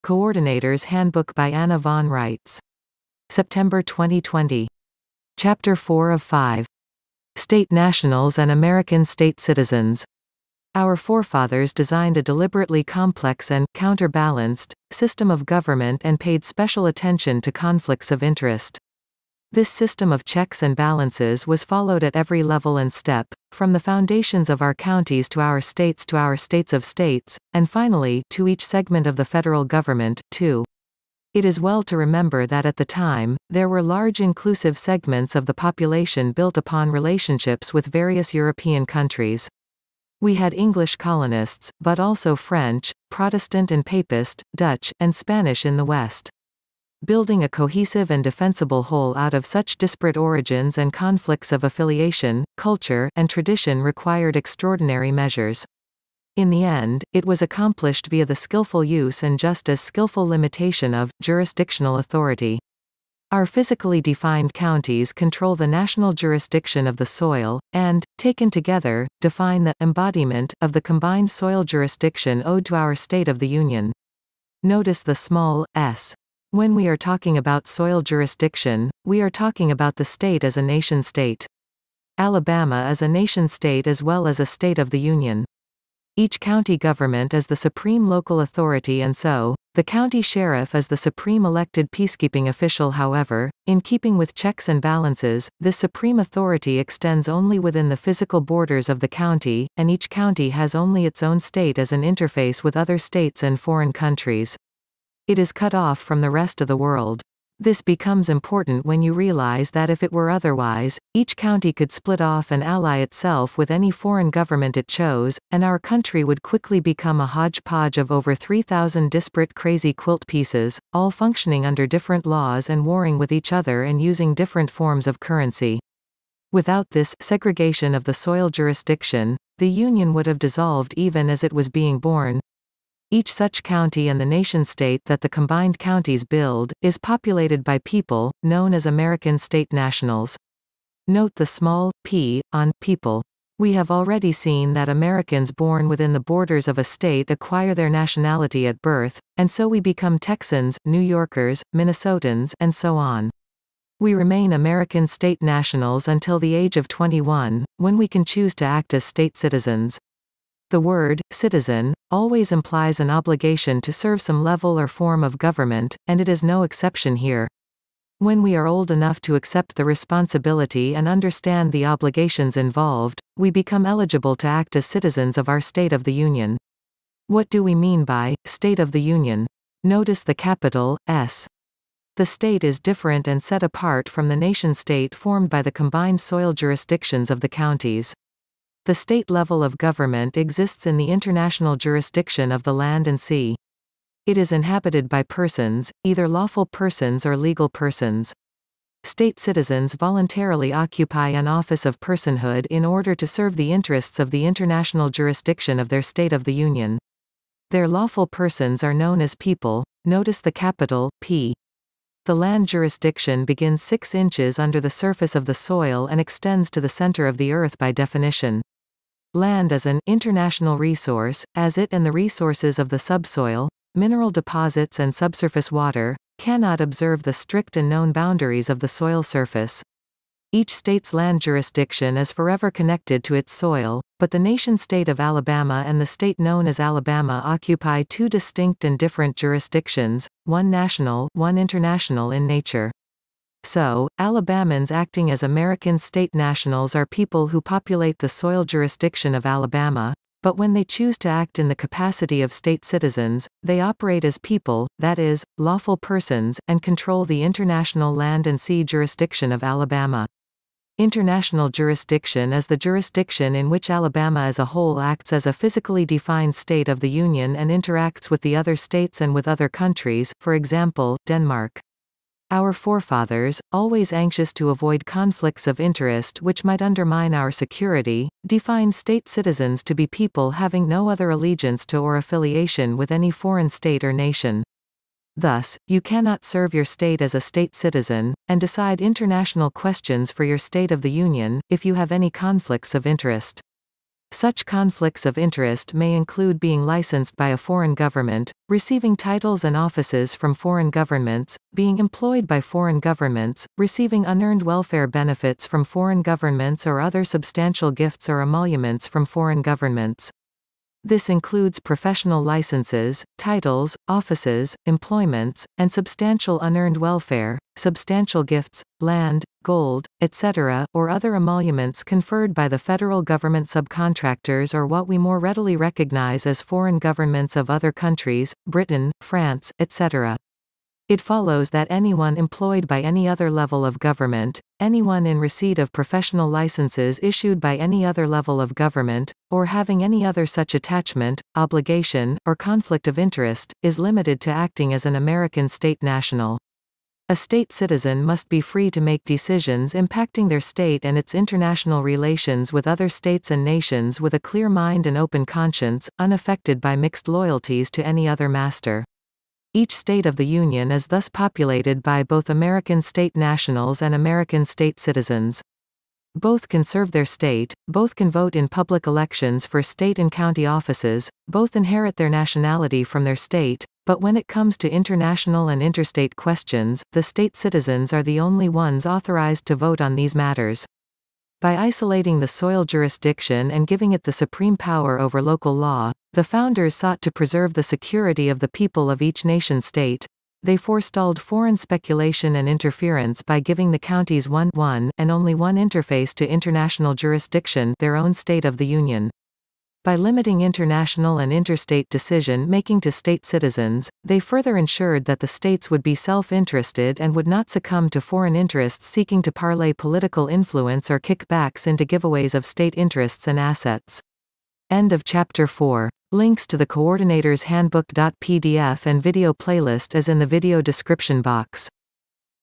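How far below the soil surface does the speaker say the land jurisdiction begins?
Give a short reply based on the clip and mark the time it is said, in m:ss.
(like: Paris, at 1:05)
6 inches, at 3:33.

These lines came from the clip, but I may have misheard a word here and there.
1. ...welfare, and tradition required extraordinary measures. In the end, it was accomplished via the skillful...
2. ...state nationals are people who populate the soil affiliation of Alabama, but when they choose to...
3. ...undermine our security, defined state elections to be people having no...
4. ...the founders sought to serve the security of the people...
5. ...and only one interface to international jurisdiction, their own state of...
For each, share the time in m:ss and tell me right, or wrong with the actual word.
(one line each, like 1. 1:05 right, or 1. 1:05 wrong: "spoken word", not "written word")
1. 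0:52 wrong: "culture", not "welfare"
2. 4:05 wrong: "jurisdiction", not "affiliation"
3. 4:36 wrong: "citizens", not "elections"
4. 6:26 wrong: "preserve", not "serve"
5. 6:35 right.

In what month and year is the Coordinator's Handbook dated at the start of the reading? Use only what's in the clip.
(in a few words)
September 2020.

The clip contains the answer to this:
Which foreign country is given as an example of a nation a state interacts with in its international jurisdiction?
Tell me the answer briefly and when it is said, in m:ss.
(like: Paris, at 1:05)
Denmark, at 4:31.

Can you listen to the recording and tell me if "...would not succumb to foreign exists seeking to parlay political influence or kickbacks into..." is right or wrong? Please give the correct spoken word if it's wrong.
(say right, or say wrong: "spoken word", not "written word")
wrong: "interests", not "exists".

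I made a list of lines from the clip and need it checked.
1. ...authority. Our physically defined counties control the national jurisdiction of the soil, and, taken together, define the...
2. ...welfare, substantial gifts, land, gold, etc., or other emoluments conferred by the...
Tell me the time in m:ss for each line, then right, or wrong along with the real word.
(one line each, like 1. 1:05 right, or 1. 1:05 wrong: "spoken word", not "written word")
1. 1:01 right
2. 5:16 right.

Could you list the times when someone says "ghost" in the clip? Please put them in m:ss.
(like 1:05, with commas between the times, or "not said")
not said.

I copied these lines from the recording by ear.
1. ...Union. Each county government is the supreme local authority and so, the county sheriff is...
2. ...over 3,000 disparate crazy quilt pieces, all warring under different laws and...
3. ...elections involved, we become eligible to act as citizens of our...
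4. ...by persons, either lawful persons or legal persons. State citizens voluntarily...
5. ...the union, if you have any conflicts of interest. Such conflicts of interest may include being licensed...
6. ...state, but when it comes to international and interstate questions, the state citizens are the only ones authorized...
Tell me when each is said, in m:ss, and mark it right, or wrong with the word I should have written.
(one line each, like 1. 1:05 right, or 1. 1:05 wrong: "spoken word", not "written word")
1. 1:24 right
2. 1:58 wrong: "functioning", not "warring"
3. 2:51 wrong: "obligations", not "elections"
4. 3:15 right
5. 4:51 right
6. 6:13 right.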